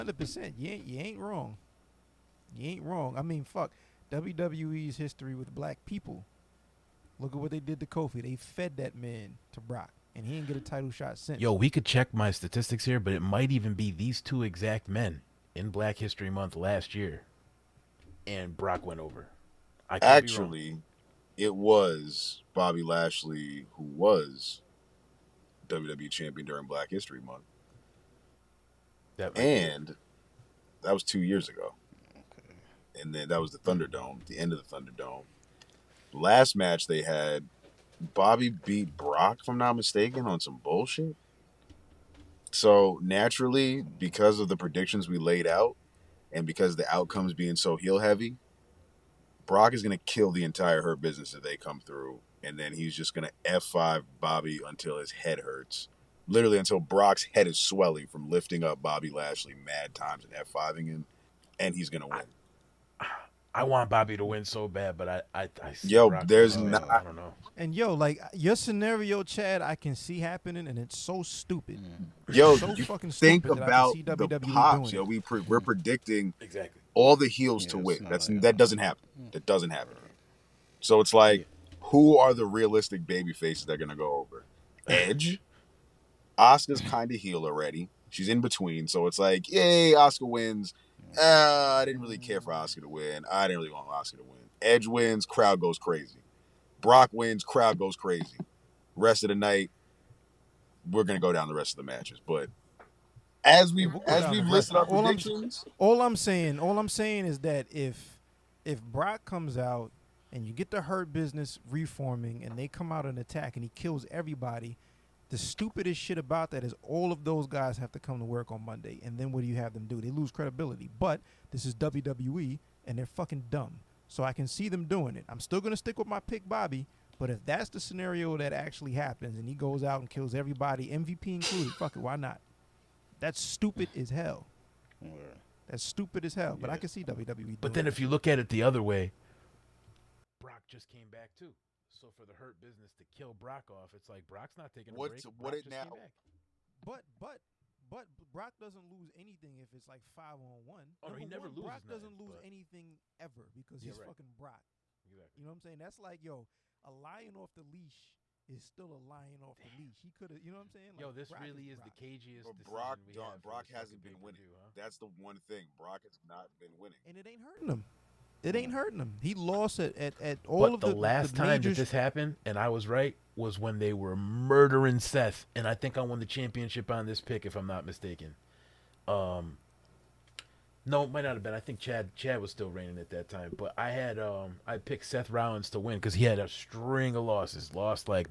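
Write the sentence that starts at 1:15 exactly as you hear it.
predicting exactly all the heels yeah, to win.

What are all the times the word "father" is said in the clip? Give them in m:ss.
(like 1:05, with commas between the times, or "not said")
not said.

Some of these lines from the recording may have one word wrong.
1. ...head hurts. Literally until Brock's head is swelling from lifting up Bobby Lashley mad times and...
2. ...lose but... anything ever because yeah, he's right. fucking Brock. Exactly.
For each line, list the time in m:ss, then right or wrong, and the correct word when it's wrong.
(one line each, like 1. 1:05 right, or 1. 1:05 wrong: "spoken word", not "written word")
1. 0:55 right
2. 2:32 right.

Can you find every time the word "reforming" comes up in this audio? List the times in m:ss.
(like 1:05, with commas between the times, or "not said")
1:51.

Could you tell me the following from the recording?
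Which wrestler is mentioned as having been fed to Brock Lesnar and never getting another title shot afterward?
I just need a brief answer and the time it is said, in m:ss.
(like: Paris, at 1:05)
Kofi, at 0:07.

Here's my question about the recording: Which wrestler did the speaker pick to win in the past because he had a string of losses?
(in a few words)
Seth Rollins.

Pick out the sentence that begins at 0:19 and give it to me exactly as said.
Actually, it was Bobby Lashley who was WWE champion during Black History Month, that and be.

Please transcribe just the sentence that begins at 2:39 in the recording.
He could have, you know what I'm saying?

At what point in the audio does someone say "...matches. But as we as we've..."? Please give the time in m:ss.
1:41.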